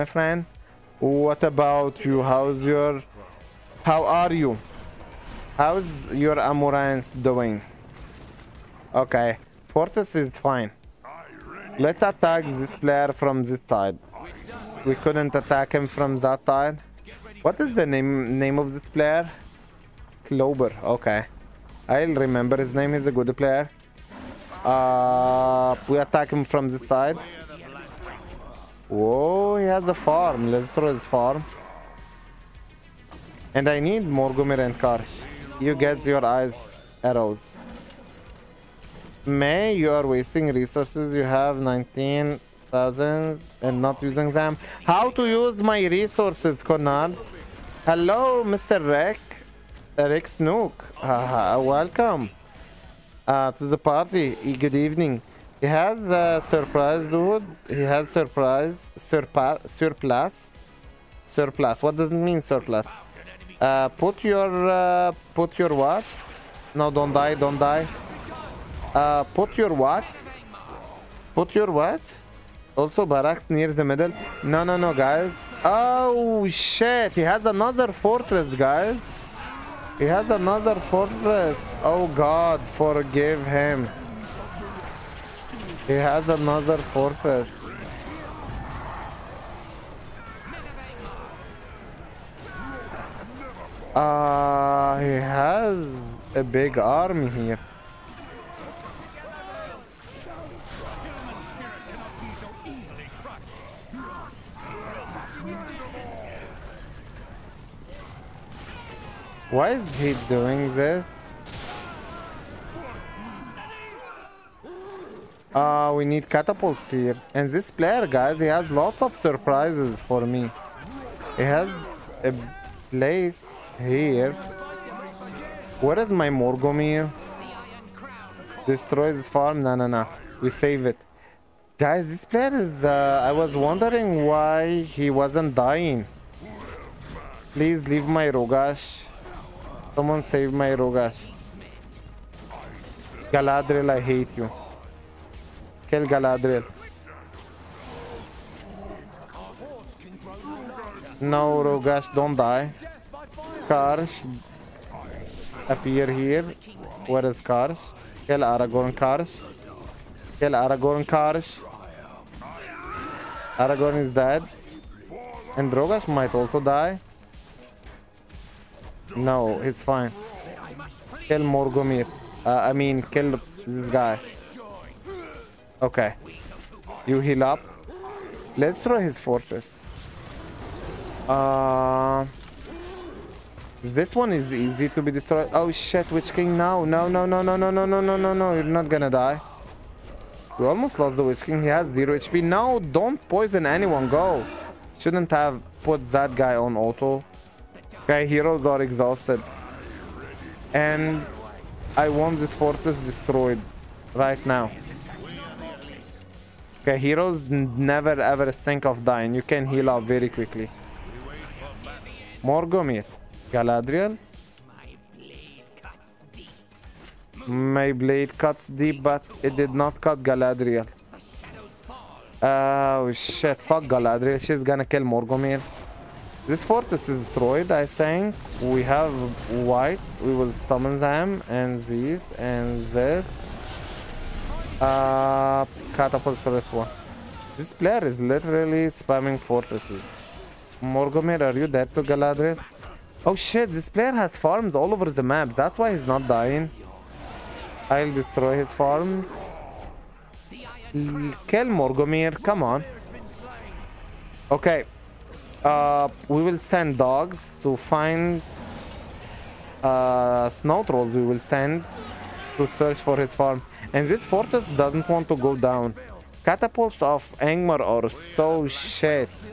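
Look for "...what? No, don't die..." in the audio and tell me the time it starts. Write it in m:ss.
1:05.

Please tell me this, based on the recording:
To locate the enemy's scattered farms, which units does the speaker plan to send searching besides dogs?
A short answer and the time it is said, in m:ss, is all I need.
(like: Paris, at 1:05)
Snow trolls, at 4:20.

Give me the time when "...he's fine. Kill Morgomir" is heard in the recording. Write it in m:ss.
2:49.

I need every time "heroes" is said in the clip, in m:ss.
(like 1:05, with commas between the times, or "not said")
3:18, 3:26.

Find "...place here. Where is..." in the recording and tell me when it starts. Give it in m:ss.
2:02.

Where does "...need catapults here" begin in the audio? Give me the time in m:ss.
1:56.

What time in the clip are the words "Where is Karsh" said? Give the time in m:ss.
2:37.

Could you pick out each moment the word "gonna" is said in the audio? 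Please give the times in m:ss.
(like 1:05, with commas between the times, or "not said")
3:08, 3:44.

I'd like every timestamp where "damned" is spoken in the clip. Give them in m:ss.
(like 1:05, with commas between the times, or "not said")
not said.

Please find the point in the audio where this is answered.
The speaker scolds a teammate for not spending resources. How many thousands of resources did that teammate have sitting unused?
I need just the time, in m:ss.
0:41.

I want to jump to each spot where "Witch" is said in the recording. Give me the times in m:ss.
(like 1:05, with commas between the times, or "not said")
3:06, 3:11.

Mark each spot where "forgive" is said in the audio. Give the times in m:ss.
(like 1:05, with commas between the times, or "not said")
1:22.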